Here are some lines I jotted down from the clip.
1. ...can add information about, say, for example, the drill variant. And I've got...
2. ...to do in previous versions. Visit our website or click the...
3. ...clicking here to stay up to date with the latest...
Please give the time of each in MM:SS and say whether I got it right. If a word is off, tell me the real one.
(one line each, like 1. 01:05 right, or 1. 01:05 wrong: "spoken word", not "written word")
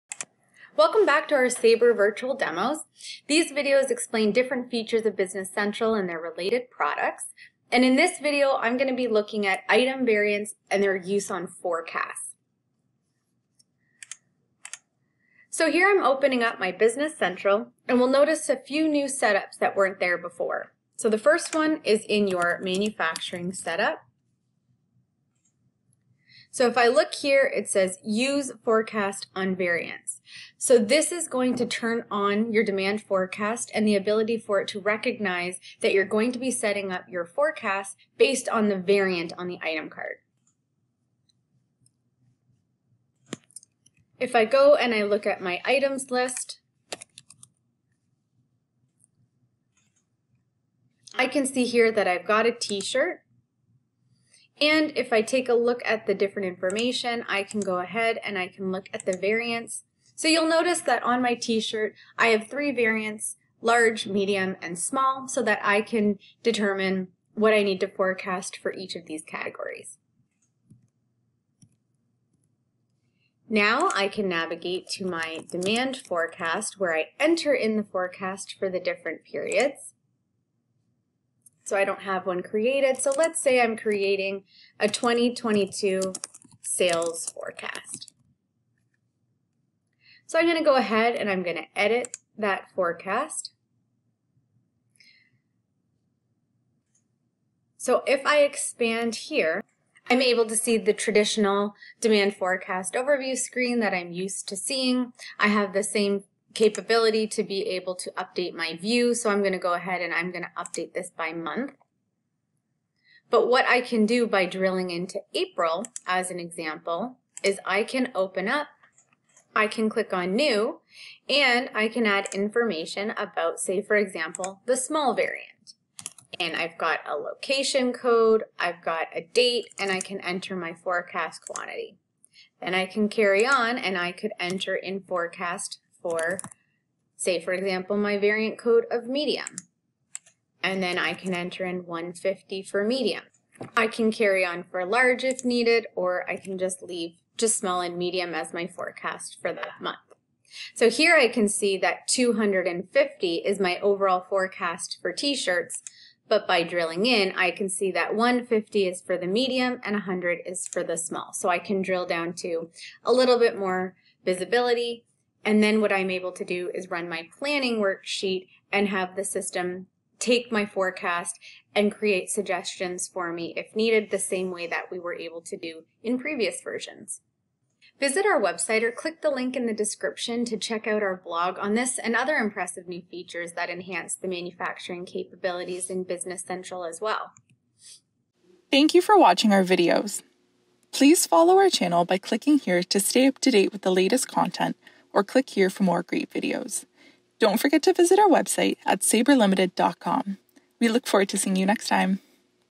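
1. 02:01 wrong: "small", not "drill"
2. 02:55 right
3. 03:12 right.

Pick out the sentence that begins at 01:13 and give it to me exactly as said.
Now I can navigate to my demand forecast where I enter in the forecast for the different periods.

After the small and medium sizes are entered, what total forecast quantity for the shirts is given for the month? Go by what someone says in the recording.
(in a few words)
250.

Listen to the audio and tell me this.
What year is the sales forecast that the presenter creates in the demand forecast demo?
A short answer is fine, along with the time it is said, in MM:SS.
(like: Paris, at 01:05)
2022, at 01:24.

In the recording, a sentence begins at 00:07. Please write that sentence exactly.
And in this video, I'm going to be looking at item variants and their use on forecasts.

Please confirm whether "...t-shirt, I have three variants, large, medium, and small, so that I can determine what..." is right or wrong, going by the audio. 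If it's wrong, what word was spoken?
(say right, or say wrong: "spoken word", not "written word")
right.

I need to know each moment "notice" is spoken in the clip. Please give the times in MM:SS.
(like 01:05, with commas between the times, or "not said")
00:18, 01:00.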